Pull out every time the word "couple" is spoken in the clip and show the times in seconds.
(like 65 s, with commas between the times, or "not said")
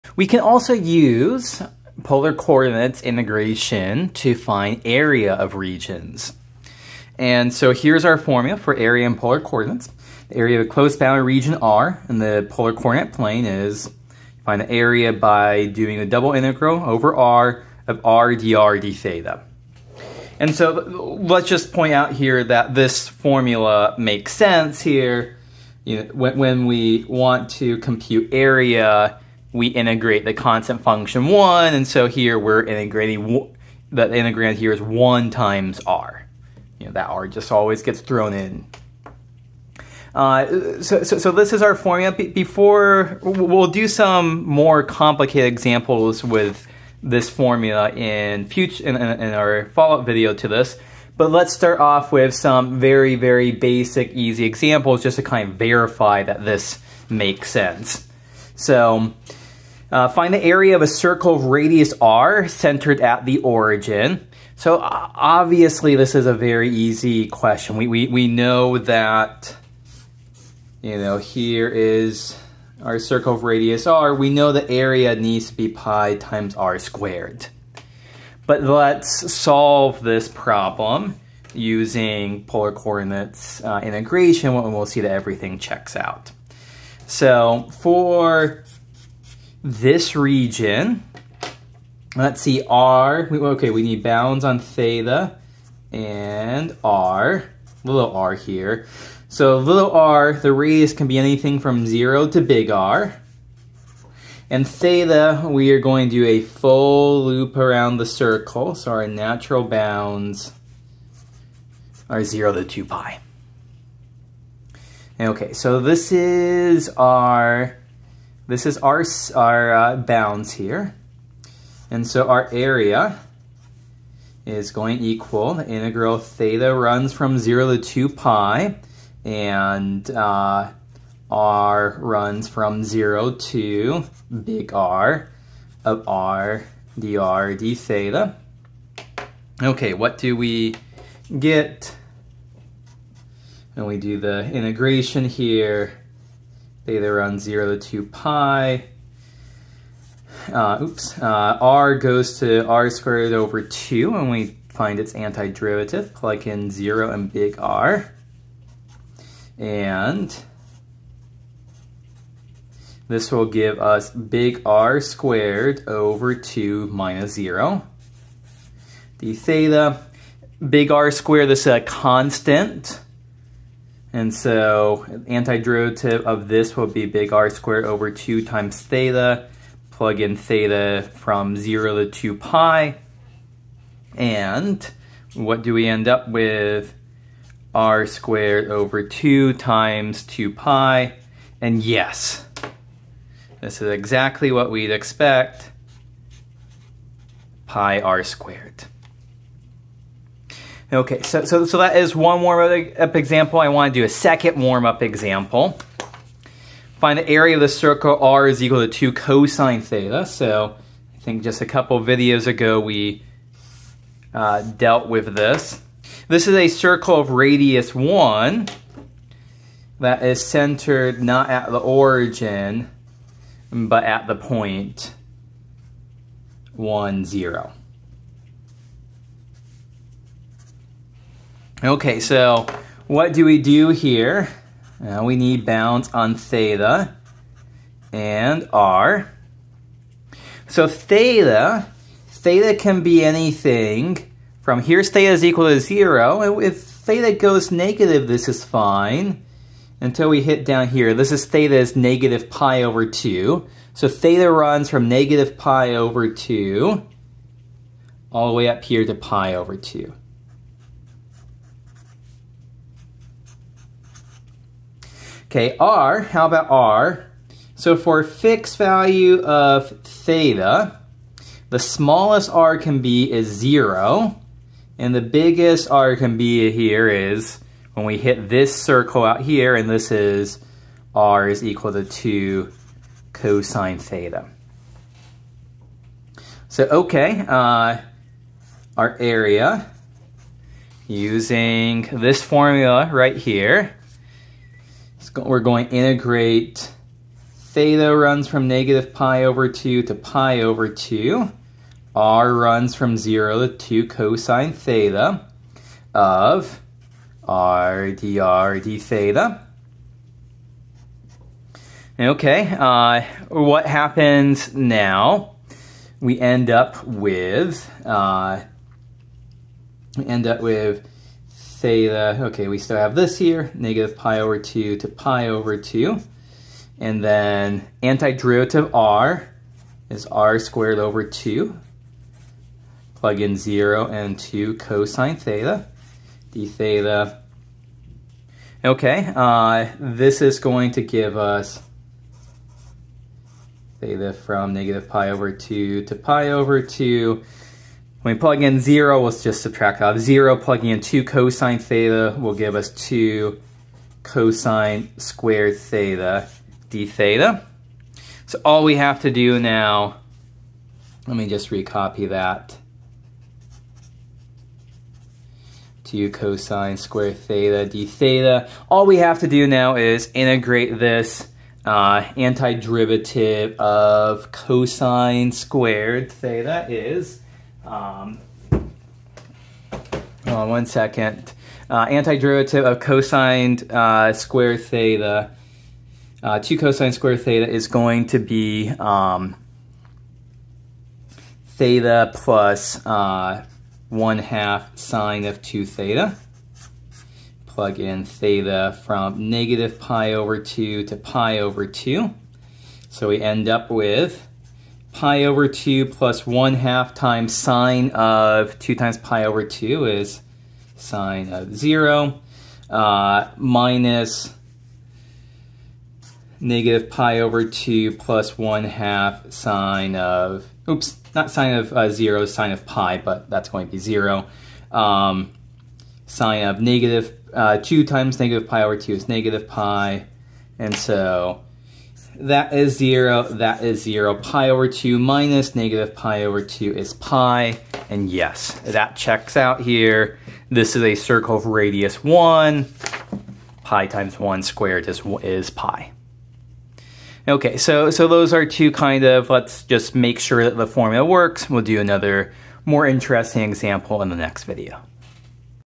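211 s.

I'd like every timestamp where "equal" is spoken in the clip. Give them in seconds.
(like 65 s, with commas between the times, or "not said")
125 s, 208 s, 245 s, 281 s.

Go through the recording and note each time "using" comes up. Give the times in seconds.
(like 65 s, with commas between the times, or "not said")
81 s, 291 s.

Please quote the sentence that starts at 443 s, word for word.
Pi times 1 squared is, is pi.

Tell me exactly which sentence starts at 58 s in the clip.
So uh, find the area of a circle of radius r centered at the origin.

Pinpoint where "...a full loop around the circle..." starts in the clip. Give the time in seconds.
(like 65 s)
106 s.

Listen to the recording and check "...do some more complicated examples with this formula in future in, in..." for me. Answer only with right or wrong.
right.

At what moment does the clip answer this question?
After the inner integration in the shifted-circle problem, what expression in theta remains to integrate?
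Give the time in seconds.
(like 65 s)
352 s.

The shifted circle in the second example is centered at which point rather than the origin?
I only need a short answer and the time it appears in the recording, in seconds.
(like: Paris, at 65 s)
(1, 0), at 224 s.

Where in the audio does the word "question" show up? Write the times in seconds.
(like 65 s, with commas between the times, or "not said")
67 s.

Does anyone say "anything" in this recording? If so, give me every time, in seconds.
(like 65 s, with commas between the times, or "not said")
101 s, 243 s.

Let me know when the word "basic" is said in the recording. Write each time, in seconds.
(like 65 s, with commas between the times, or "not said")
53 s.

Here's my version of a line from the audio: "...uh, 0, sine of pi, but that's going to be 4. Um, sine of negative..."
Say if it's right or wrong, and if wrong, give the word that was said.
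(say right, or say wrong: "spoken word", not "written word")
wrong: "0", not "4".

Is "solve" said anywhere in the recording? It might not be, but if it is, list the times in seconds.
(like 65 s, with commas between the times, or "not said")
79 s.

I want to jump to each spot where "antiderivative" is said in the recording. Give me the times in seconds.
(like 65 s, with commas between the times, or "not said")
155 s, 175 s, 328 s, 372 s, 382 s.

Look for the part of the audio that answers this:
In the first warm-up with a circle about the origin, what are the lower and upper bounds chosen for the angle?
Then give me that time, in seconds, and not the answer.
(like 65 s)
112 s.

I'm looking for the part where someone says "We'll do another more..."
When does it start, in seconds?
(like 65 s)
451 s.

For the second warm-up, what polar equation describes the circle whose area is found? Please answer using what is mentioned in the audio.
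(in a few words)
r = 2 cos theta.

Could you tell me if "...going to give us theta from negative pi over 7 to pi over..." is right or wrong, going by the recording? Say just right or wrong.
wrong.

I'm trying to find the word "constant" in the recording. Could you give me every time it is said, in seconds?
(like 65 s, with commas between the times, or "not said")
30 s, 171 s.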